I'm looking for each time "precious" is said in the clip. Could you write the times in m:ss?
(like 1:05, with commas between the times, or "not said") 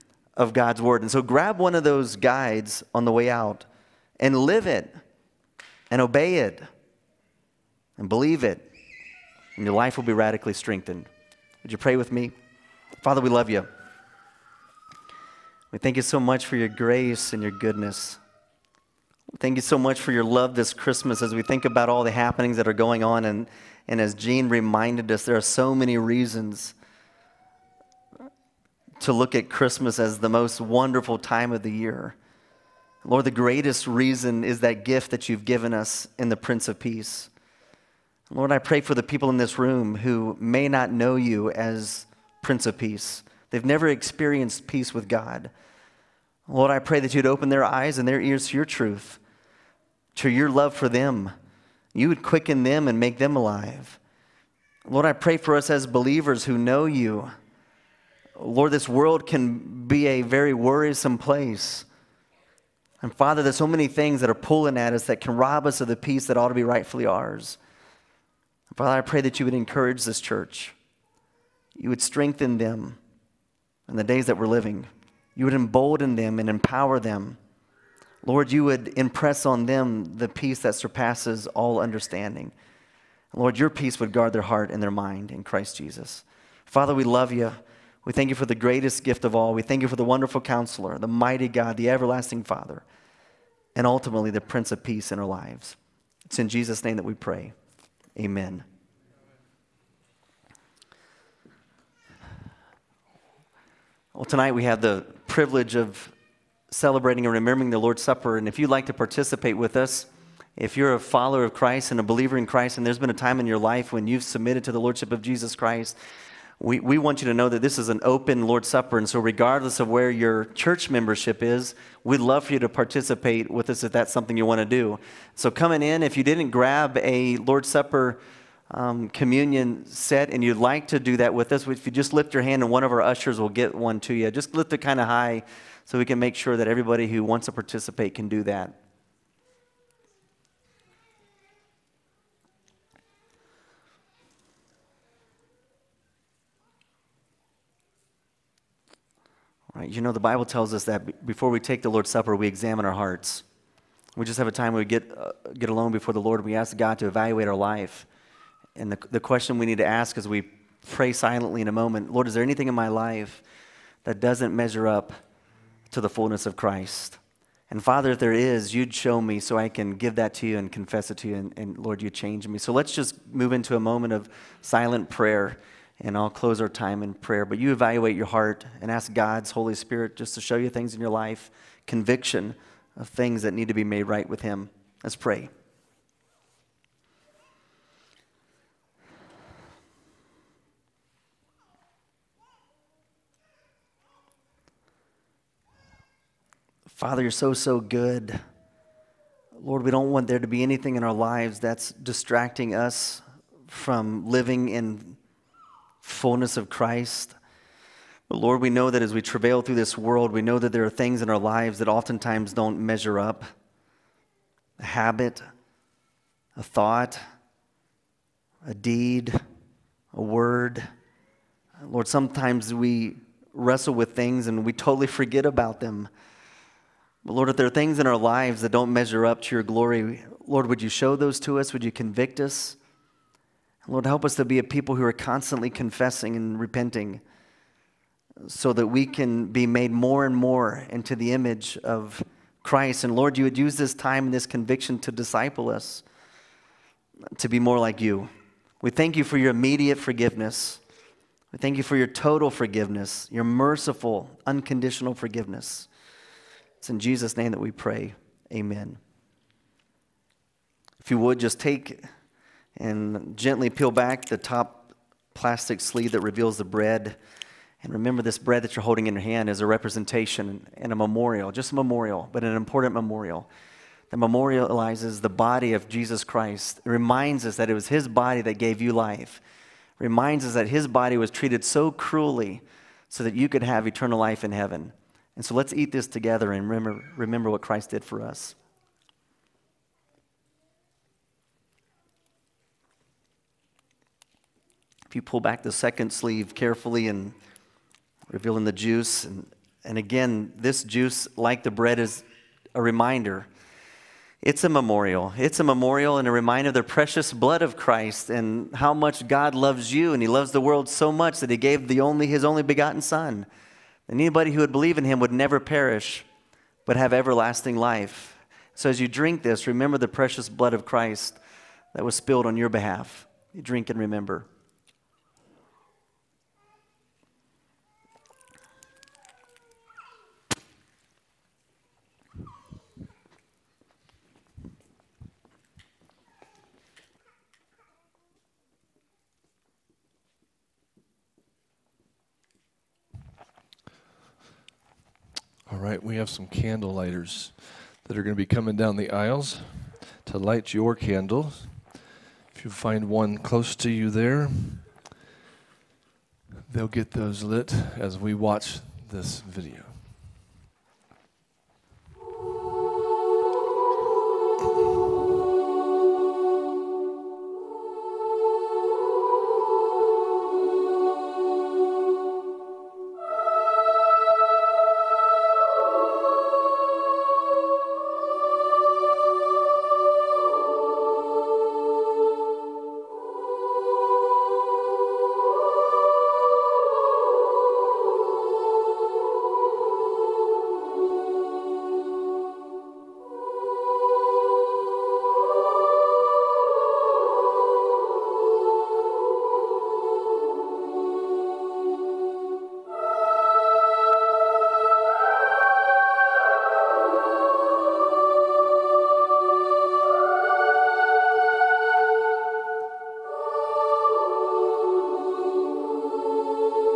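5:06, 5:20.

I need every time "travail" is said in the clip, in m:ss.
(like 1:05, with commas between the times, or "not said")
3:29.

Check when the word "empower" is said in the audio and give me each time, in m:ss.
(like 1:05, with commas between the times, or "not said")
1:16.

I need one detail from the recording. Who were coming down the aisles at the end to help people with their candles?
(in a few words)
candle lighters.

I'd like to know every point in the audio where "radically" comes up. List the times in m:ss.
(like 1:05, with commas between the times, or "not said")
0:10.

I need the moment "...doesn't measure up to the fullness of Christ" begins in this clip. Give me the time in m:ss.
2:44.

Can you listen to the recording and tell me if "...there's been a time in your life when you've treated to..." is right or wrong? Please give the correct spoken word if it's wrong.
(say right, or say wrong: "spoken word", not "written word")
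wrong: "submitted", not "treated".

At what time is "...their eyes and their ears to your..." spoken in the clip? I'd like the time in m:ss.
0:47.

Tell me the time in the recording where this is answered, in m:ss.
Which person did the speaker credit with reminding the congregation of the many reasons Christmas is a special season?
0:24.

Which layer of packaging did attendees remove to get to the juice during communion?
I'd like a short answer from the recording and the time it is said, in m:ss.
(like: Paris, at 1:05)
the second sleeve, at 4:55.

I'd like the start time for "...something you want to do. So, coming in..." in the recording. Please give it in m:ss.
2:04.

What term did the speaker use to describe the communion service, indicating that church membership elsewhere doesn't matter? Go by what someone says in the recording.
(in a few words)
open Lord's Supper.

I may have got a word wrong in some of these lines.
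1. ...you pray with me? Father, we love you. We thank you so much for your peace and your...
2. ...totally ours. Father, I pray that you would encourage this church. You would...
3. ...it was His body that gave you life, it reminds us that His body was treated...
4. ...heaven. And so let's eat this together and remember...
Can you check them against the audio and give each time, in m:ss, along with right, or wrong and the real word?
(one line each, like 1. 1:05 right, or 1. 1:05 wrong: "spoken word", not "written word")
1. 0:11 wrong: "grace", not "peace"
2. 1:06 wrong: "rightfully", not "totally"
3. 4:37 right
4. 4:44 right.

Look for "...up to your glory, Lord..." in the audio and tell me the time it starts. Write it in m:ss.
3:49.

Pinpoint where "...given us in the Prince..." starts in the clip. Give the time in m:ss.
0:35.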